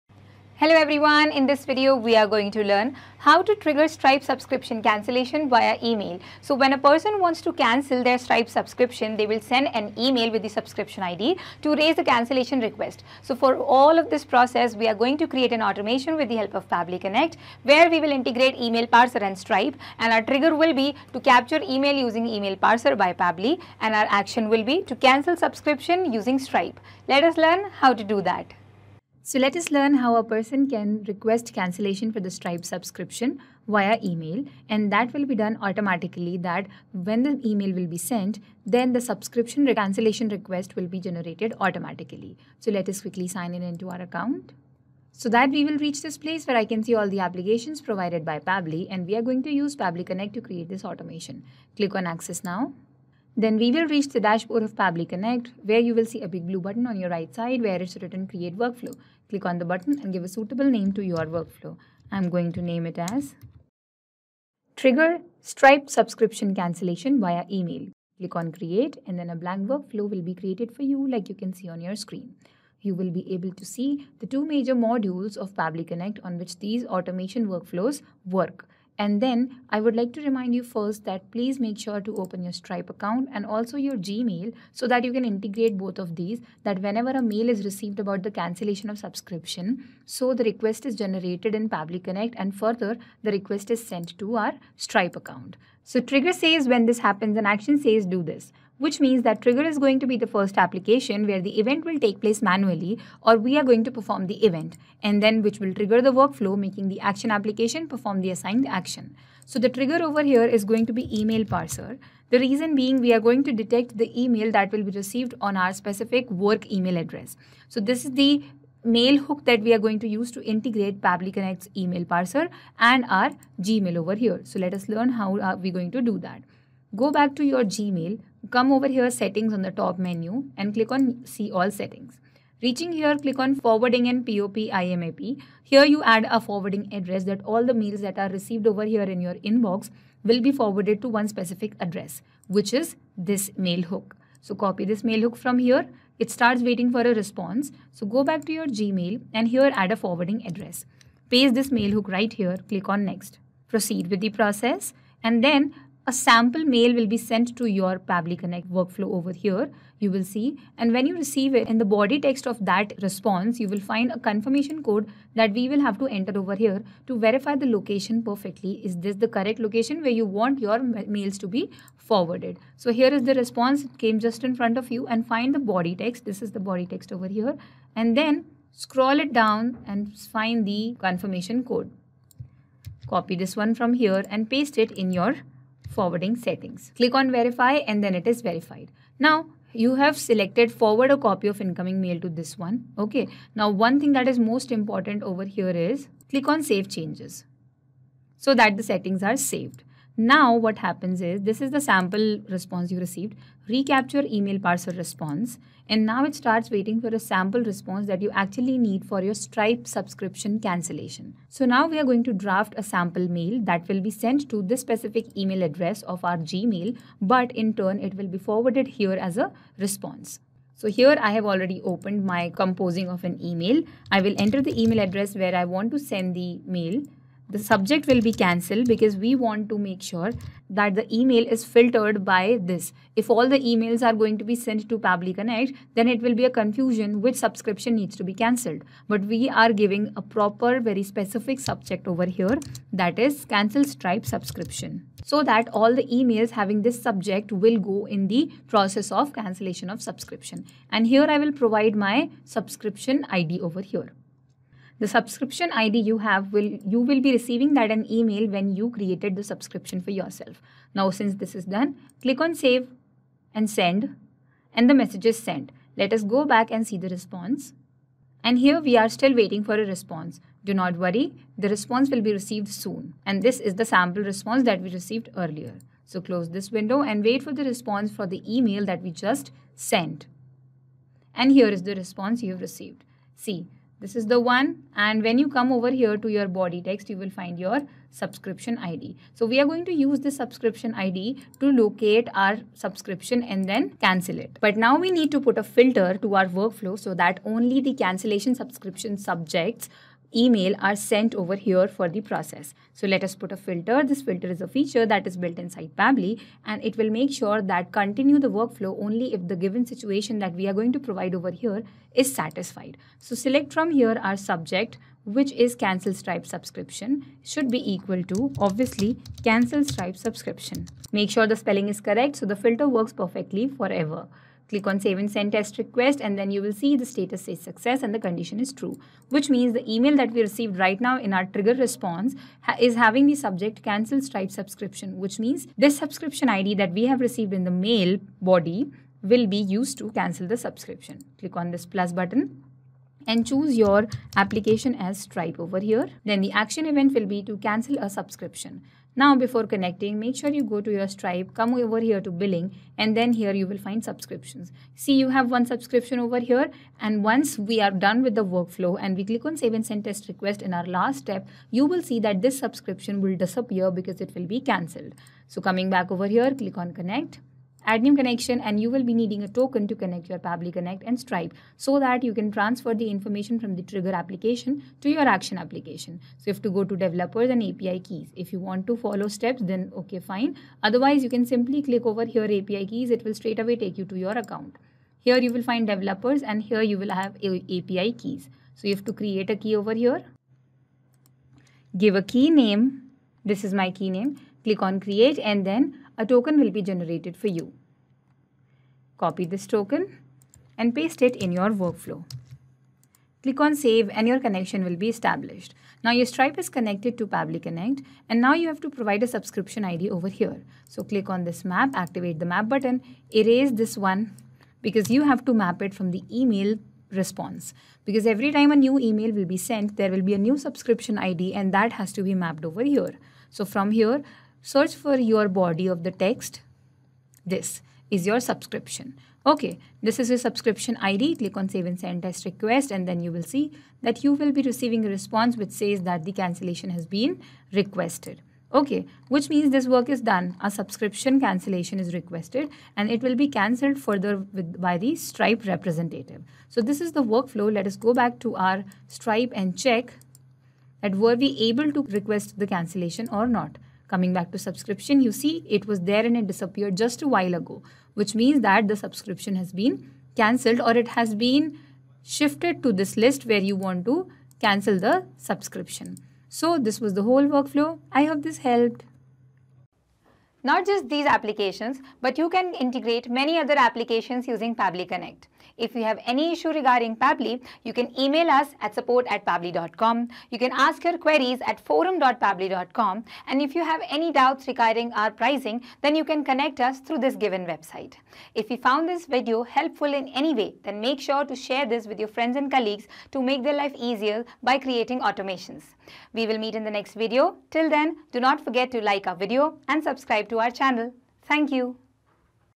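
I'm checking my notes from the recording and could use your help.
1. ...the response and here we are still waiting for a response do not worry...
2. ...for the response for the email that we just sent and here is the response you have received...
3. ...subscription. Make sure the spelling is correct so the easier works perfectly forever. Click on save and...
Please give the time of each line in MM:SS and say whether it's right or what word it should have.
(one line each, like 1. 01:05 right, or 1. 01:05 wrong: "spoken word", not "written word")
1. 04:27 right
2. 04:37 right
3. 05:20 wrong: "filter", not "easier".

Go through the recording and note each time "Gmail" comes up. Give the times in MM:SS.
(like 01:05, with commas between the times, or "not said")
01:23, 02:03, 02:07, 02:28, 03:36.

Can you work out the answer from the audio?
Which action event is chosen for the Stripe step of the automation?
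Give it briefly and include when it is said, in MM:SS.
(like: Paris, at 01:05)
Cancel a subscription, at 05:47.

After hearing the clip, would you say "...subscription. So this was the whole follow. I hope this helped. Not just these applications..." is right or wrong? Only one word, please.
wrong.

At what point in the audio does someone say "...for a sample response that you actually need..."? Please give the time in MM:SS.
03:27.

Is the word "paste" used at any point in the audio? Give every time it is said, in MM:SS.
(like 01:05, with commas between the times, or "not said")
02:31, 03:04, 06:40.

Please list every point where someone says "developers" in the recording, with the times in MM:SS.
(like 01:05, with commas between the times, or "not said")
06:16, 06:25.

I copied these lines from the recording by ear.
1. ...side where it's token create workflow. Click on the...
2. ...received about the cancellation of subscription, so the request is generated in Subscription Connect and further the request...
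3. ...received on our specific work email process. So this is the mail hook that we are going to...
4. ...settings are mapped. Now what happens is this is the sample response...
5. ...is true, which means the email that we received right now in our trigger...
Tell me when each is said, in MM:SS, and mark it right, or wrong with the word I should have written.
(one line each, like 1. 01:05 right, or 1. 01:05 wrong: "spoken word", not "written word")
1. 00:57 wrong: "written", not "token"
2. 01:27 wrong: "Pabbly", not "Subscription"
3. 01:54 wrong: "address", not "process"
4. 03:18 wrong: "saved", not "mapped"
5. 05:28 right.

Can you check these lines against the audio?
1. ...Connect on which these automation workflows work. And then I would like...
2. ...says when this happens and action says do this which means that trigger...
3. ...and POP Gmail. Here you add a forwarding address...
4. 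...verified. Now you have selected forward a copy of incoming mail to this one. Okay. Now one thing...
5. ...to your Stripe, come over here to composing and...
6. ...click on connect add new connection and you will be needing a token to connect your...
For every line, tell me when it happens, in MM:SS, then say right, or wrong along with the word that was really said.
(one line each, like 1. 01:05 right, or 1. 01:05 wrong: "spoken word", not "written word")
1. 01:15 right
2. 01:36 right
3. 02:14 wrong: "IMAP", not "Gmail"
4. 03:08 right
5. 05:50 wrong: "billing", not "composing"
6. 06:06 right.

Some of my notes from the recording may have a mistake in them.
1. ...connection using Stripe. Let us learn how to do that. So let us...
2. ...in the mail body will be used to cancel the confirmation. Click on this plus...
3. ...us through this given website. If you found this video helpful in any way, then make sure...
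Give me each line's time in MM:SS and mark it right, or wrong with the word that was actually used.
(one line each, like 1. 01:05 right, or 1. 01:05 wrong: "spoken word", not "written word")
1. 00:25 wrong: "subscription", not "connection"
2. 05:37 wrong: "subscription", not "confirmation"
3. 08:06 right.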